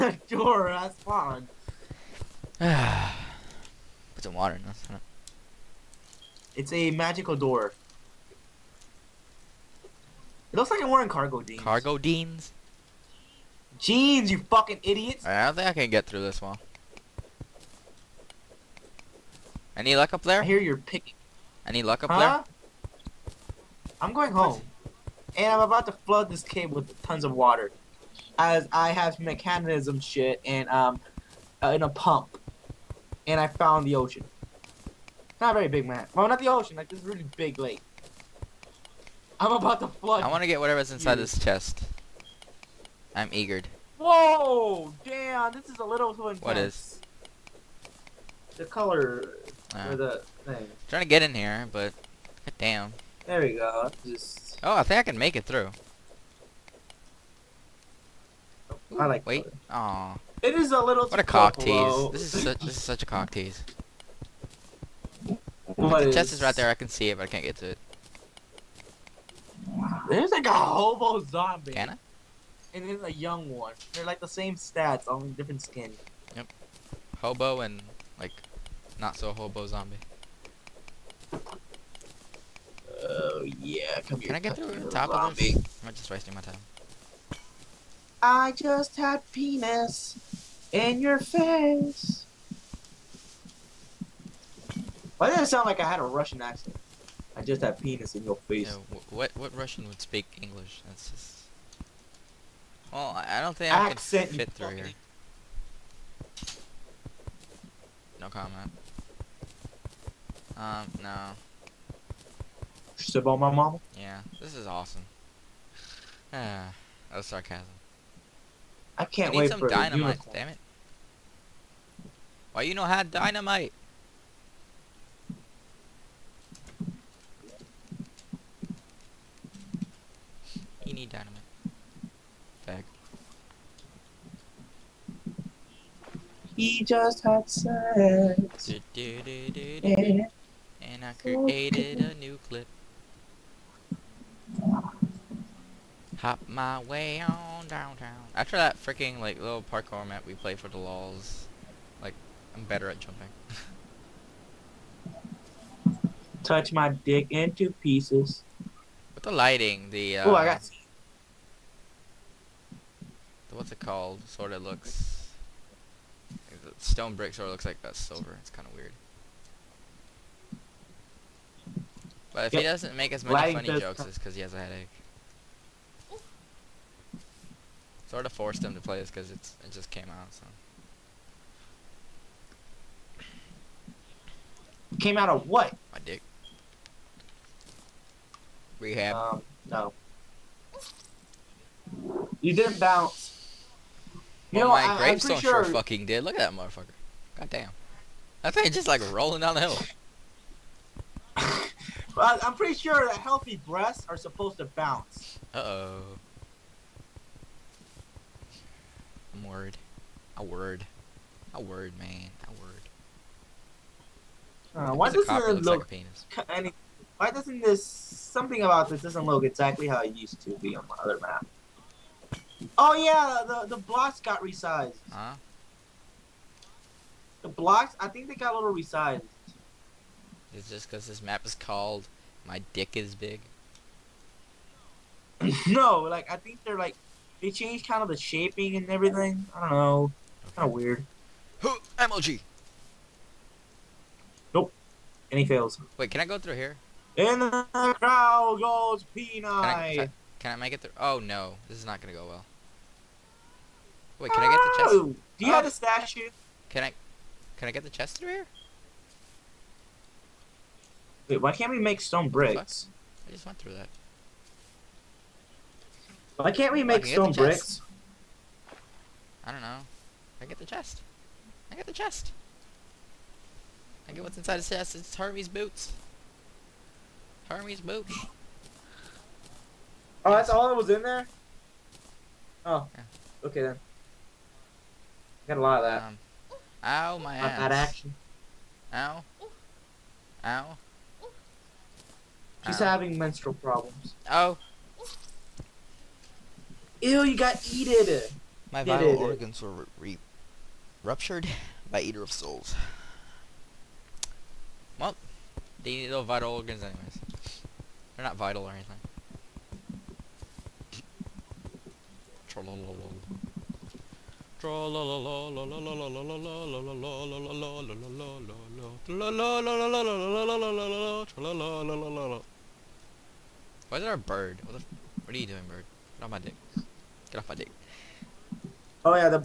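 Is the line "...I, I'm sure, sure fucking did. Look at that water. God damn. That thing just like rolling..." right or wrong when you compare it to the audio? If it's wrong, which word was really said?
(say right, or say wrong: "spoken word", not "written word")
wrong: "motherfucker", not "water".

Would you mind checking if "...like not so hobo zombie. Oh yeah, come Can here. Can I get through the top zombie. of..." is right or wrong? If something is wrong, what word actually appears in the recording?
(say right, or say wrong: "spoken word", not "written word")
right.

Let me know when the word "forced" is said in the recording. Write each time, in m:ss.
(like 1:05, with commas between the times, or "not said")
2:58.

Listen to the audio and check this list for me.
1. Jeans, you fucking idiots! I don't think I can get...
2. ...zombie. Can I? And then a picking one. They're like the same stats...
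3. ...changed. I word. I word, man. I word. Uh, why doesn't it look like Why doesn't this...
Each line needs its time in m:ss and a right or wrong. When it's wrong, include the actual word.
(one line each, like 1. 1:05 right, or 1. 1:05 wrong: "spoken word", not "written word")
1. 0:13 right
2. 1:11 wrong: "young", not "picking"
3. 3:29 wrong: "worried", not "changed".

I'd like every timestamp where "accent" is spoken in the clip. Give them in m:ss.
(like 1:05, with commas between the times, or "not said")
1:36, 1:43.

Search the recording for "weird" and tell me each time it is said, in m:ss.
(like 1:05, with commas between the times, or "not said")
2:48, 4:00.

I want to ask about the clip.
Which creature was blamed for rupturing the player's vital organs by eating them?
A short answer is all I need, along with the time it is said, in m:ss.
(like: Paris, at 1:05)
Eater of Souls, at 5:02.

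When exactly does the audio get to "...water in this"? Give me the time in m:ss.
0:04.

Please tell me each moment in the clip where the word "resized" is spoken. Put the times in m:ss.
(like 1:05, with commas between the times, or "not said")
3:44, 3:48.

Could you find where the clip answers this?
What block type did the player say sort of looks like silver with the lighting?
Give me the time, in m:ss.
2:46.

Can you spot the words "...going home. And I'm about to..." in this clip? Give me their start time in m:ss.
0:24.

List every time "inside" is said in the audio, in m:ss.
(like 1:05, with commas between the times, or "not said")
0:40, 4:34.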